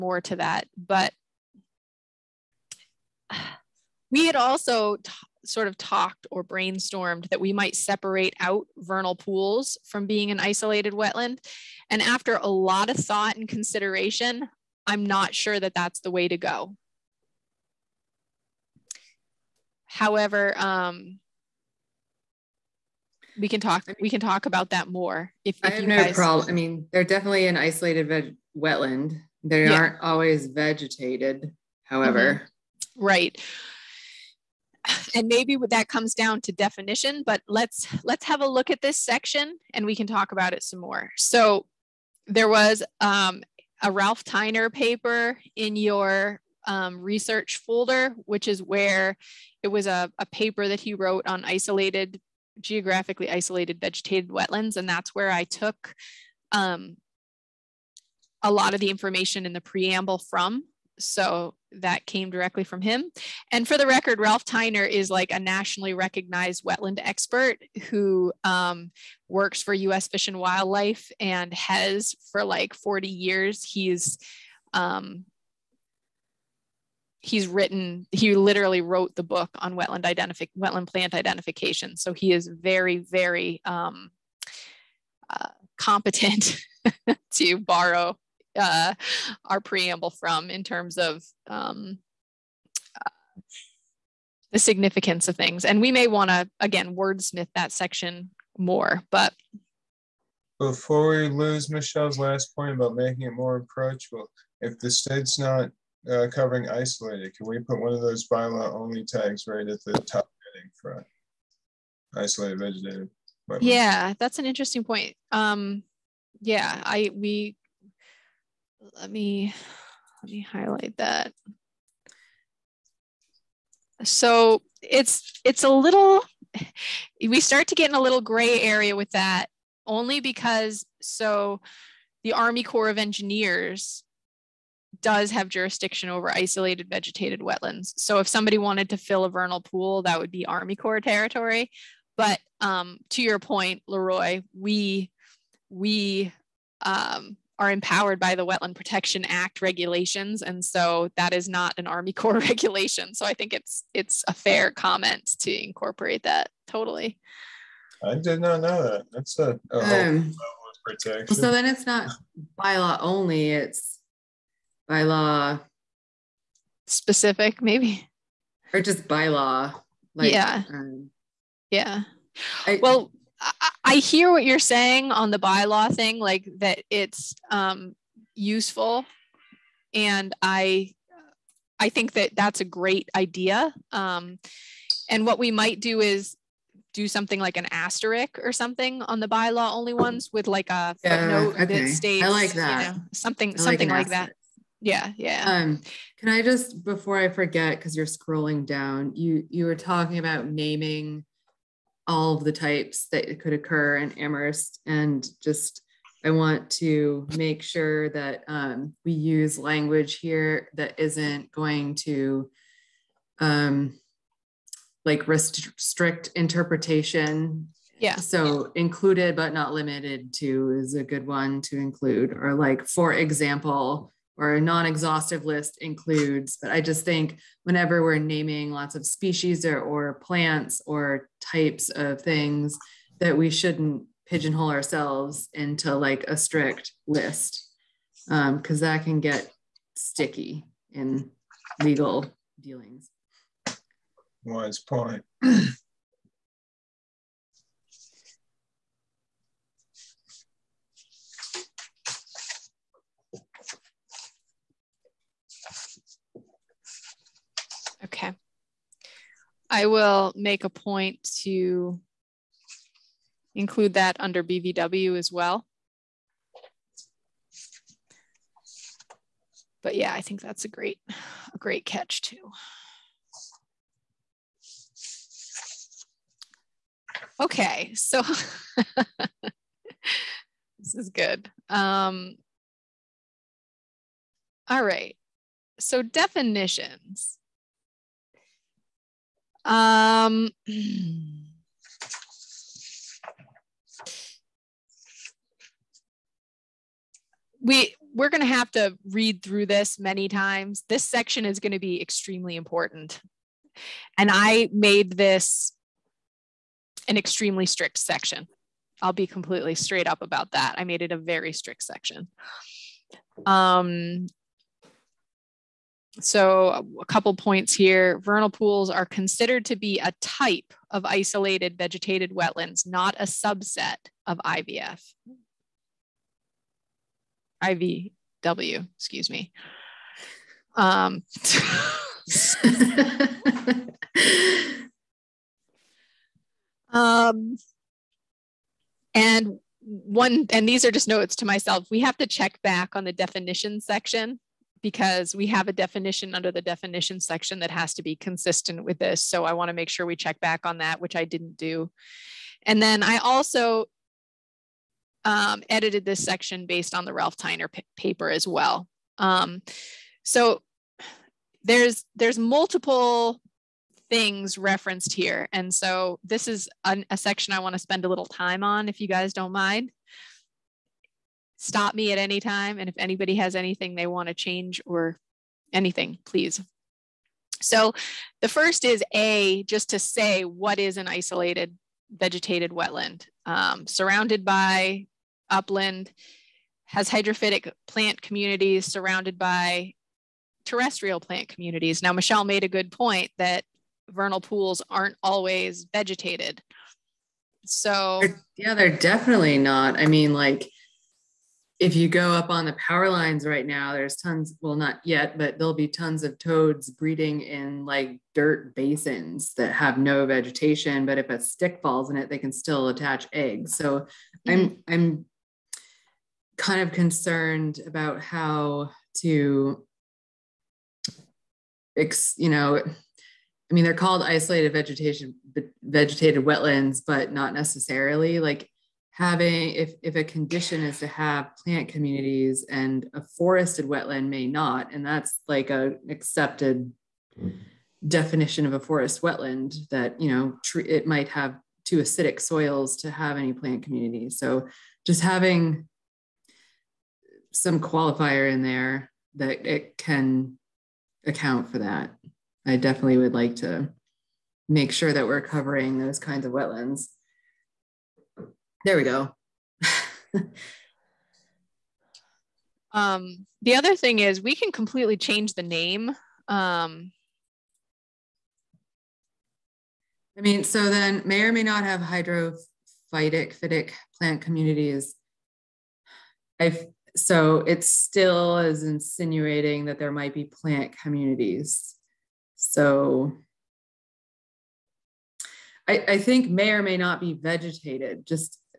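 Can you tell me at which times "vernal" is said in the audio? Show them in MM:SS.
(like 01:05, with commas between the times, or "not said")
00:08, 02:19, 05:18, 06:34.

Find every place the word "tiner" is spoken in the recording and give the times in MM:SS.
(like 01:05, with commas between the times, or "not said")
00:44, 01:04, 05:57.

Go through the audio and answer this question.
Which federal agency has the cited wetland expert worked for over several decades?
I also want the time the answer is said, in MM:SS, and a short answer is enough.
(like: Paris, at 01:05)
US Fish and Wildlife, at 01:09.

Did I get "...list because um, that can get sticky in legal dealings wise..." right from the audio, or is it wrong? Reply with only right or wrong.
right.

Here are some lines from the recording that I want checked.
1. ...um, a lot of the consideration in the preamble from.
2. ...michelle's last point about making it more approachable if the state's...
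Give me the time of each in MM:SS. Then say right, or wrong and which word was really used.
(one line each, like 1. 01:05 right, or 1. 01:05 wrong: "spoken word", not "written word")
1. 00:56 wrong: "information", not "consideration"
2. 01:41 right.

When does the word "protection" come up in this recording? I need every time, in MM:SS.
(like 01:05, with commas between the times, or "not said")
02:28, 02:40.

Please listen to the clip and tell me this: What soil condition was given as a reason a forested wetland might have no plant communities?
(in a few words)
too acidic.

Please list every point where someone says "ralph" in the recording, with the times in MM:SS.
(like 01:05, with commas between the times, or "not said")
00:43, 01:04, 05:57.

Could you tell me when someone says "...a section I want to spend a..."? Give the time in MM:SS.
06:07.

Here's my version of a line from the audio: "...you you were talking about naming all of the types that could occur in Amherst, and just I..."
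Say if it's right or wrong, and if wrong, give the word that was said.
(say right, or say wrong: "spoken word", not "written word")
right.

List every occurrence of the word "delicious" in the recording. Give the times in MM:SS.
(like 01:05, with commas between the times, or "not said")
not said.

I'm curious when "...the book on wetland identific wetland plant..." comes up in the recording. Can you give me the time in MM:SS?
01:19.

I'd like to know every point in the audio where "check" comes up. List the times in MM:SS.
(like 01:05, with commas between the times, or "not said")
05:42, 05:50.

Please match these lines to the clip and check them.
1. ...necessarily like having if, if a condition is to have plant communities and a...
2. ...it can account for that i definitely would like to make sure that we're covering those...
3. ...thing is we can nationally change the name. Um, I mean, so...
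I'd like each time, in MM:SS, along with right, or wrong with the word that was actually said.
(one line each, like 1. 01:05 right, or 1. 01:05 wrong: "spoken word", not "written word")
1. 07:07 right
2. 07:29 right
3. 07:43 wrong: "completely", not "nationally".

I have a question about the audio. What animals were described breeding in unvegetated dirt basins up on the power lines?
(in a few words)
toads.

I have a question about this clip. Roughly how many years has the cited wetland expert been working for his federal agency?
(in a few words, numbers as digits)
40.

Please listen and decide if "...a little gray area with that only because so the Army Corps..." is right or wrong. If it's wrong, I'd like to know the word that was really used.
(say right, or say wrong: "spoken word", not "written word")
right.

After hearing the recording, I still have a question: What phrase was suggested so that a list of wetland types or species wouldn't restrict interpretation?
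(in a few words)
included but not limited to.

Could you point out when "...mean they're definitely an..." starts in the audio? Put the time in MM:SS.
00:26.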